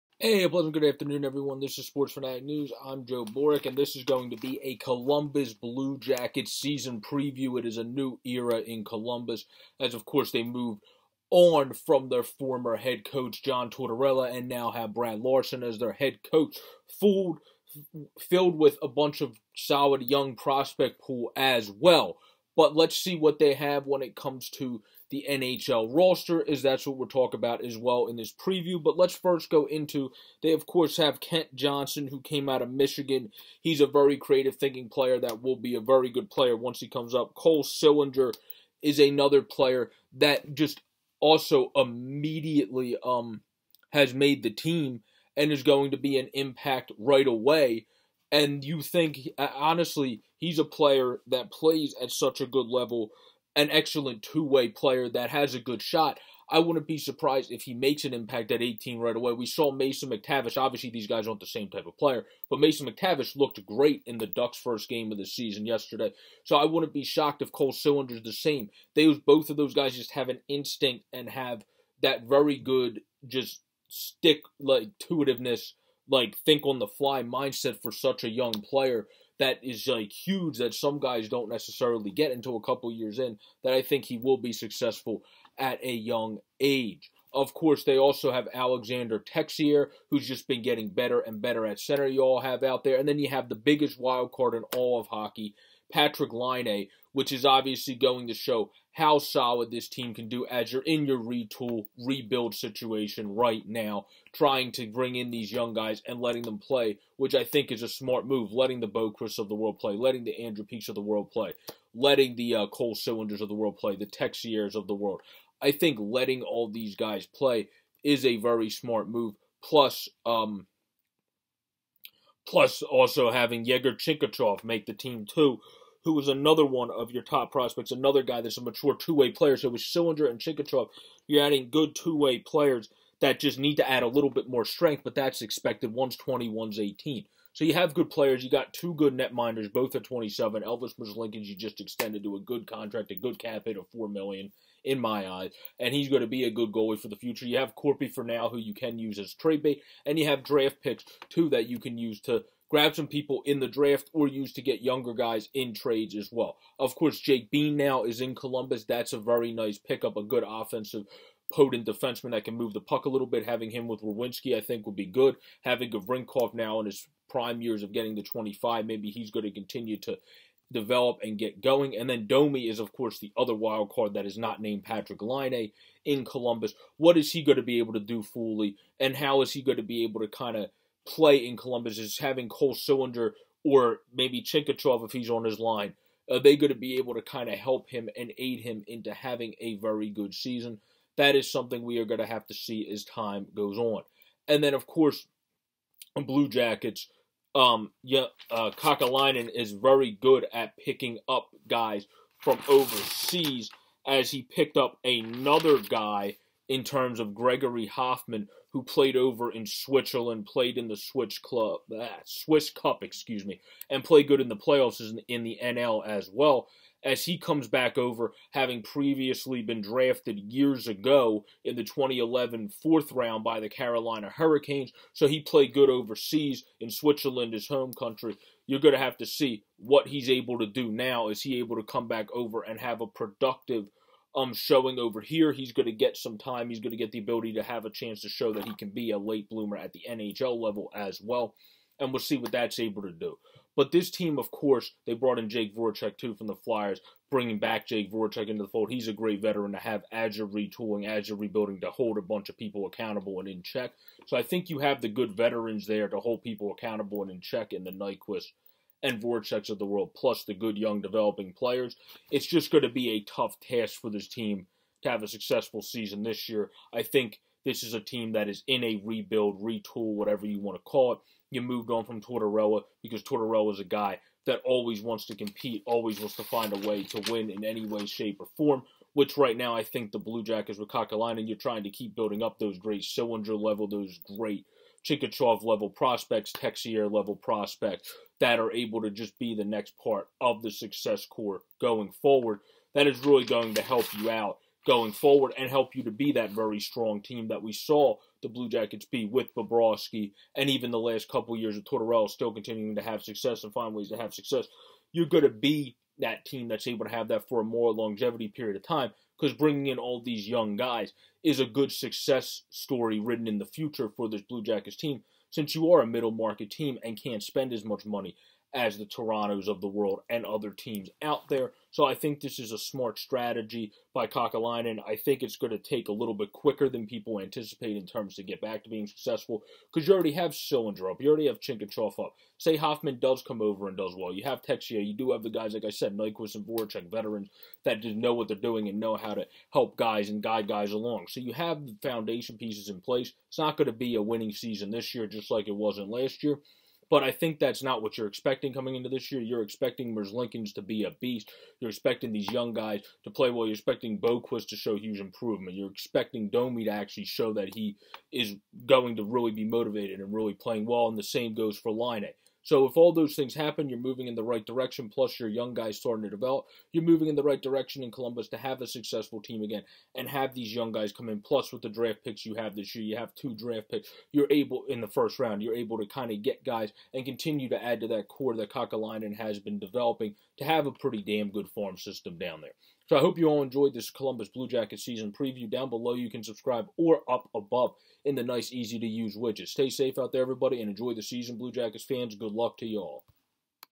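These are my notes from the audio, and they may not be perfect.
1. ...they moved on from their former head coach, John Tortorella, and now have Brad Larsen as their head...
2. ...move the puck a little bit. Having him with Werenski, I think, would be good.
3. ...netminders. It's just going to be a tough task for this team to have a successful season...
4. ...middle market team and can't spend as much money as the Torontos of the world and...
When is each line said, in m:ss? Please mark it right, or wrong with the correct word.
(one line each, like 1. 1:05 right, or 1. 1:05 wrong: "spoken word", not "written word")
1. 0:10 right
2. 2:42 right
3. 4:21 wrong: "players", not "netminders"
4. 5:16 right.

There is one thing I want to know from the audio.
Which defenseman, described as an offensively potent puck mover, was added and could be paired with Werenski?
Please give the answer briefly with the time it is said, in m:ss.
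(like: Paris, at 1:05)
Jake Bean, at 2:37.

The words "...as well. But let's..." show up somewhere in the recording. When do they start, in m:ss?
0:21.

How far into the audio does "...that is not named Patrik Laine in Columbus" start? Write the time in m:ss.
2:54.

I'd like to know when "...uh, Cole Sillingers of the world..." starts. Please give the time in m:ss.
1:52.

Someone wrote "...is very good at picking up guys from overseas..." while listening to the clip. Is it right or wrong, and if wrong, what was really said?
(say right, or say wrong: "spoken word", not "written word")
right.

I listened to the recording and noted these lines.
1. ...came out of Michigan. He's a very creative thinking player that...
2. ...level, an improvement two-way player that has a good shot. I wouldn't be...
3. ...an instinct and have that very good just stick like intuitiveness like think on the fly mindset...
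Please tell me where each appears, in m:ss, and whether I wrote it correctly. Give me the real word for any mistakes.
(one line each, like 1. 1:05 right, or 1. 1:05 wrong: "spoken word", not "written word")
1. 0:32 right
2. 0:52 wrong: "excellent", not "improvement"
3. 1:10 right.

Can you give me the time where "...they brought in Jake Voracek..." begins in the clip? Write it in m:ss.
4:05.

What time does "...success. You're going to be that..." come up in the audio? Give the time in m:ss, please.
5:04.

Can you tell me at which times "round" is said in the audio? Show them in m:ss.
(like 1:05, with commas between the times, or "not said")
3:43, 6:15.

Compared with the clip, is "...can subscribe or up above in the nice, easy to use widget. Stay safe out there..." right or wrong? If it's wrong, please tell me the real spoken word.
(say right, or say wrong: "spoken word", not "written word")
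right.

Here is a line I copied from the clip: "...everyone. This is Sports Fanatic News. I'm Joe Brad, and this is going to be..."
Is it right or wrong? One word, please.
wrong.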